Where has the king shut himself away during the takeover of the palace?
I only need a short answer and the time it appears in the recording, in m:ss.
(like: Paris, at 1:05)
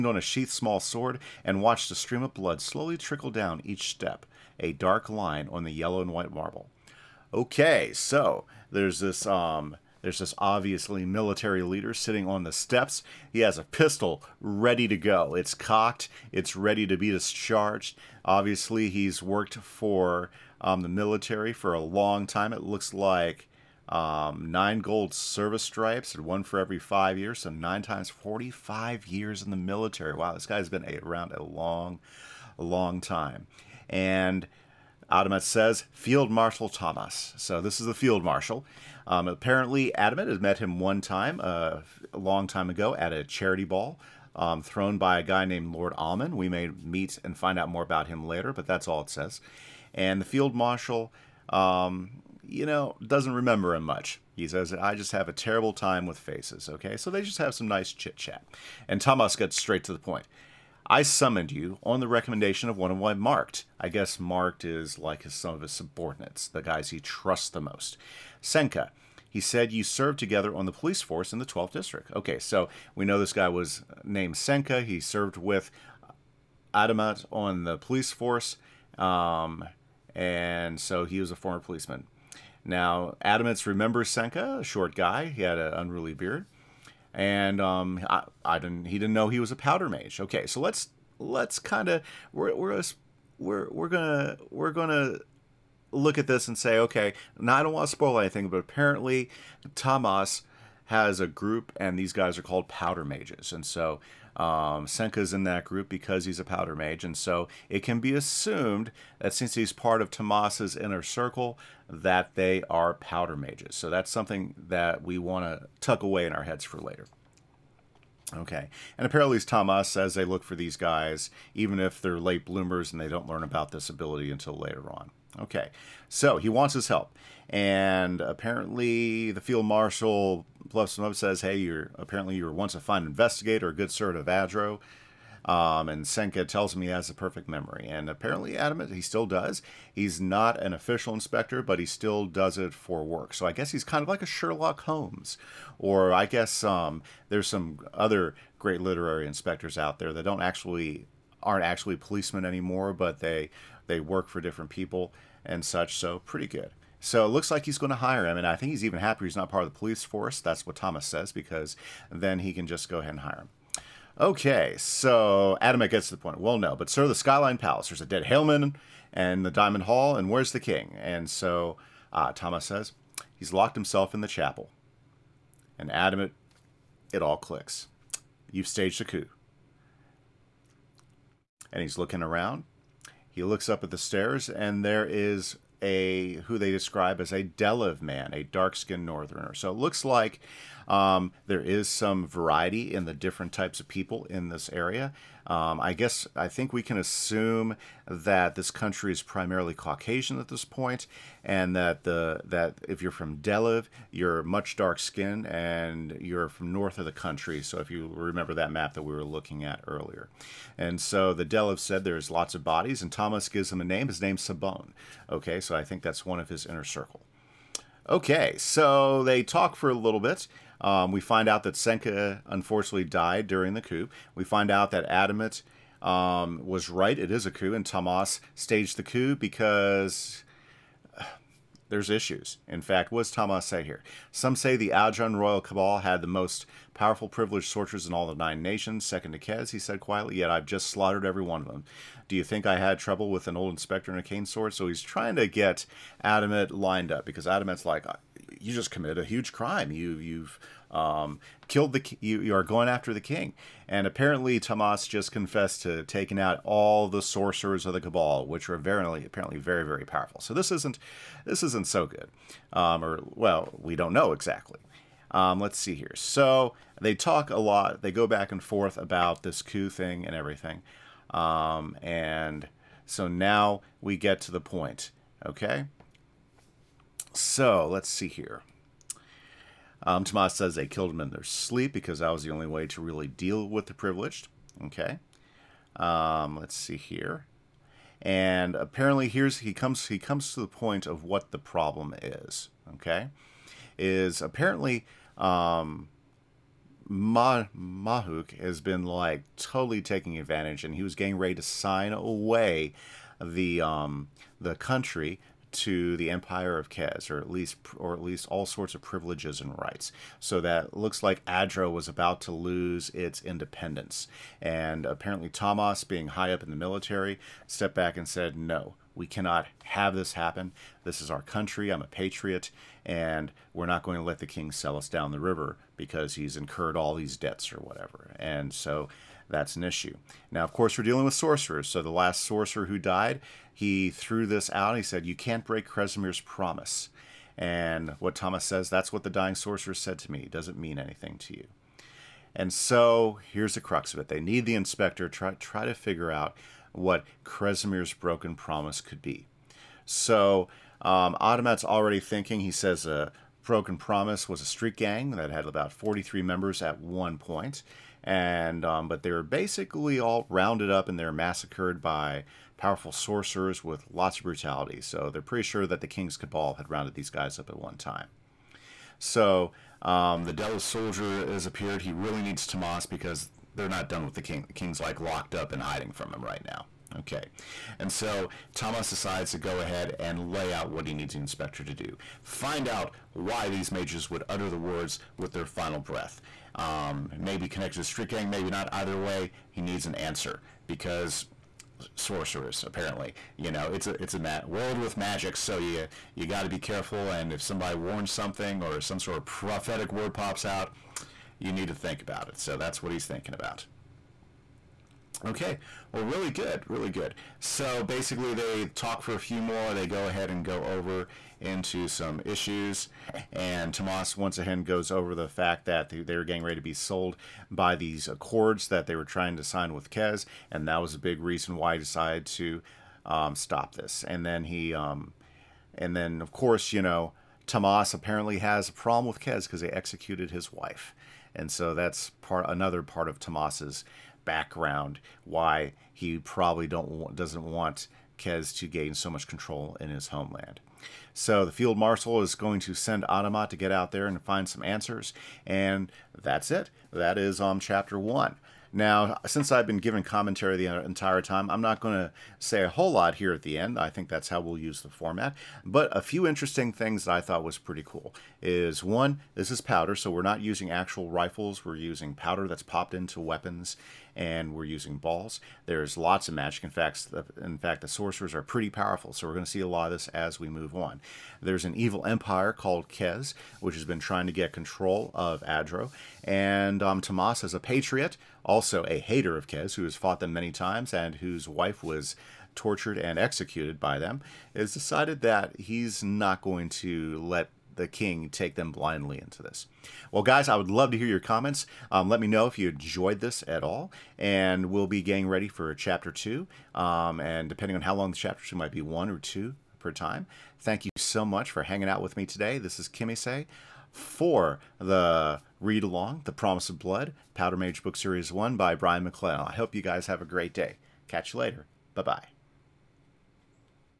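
The chapel, at 2:54.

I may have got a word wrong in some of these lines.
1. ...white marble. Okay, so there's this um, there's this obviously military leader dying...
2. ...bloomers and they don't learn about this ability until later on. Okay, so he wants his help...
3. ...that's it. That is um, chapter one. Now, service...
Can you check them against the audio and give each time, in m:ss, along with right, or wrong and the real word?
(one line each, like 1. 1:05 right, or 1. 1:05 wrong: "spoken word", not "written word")
1. 0:06 wrong: "sitting", not "dying"
2. 2:02 right
3. 7:26 wrong: "since", not "service".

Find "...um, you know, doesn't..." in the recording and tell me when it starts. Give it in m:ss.
0:51.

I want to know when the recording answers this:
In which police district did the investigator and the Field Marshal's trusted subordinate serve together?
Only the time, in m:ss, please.
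1:11.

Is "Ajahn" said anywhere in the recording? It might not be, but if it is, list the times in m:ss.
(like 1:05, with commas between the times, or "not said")
3:54.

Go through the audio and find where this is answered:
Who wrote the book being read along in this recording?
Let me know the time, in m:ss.
8:28.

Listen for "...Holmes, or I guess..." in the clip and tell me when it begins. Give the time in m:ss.
2:24.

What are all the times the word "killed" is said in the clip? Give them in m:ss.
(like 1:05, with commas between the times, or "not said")
4:11, 4:40.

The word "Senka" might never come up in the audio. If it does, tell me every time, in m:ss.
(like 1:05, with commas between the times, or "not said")
1:08, 1:14, 1:24, 1:44, 2:16, 3:41.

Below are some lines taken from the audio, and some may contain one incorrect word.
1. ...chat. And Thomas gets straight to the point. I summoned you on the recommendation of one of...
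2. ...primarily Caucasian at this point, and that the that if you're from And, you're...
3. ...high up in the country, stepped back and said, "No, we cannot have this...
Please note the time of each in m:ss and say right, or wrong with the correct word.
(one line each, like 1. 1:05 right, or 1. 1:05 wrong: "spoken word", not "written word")
1. 0:58 right
2. 3:19 wrong: "Deliv", not "And"
3. 5:16 wrong: "military", not "country".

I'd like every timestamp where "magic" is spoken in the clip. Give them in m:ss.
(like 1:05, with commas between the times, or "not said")
6:35, 7:46.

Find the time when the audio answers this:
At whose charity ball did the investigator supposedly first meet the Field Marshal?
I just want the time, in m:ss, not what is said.
0:45.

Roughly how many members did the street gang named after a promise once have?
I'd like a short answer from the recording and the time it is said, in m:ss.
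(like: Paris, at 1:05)
43, at 5:55.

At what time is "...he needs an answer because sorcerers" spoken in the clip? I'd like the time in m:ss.
6:29.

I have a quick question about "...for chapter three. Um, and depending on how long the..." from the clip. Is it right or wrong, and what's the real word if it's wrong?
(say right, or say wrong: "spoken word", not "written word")
wrong: "two", not "three".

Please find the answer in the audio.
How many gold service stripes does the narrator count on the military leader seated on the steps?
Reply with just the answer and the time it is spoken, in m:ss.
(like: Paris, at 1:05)
9, at 0:24.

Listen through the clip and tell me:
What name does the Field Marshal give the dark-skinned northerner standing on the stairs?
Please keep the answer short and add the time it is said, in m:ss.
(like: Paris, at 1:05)
Sabon, at 3:34.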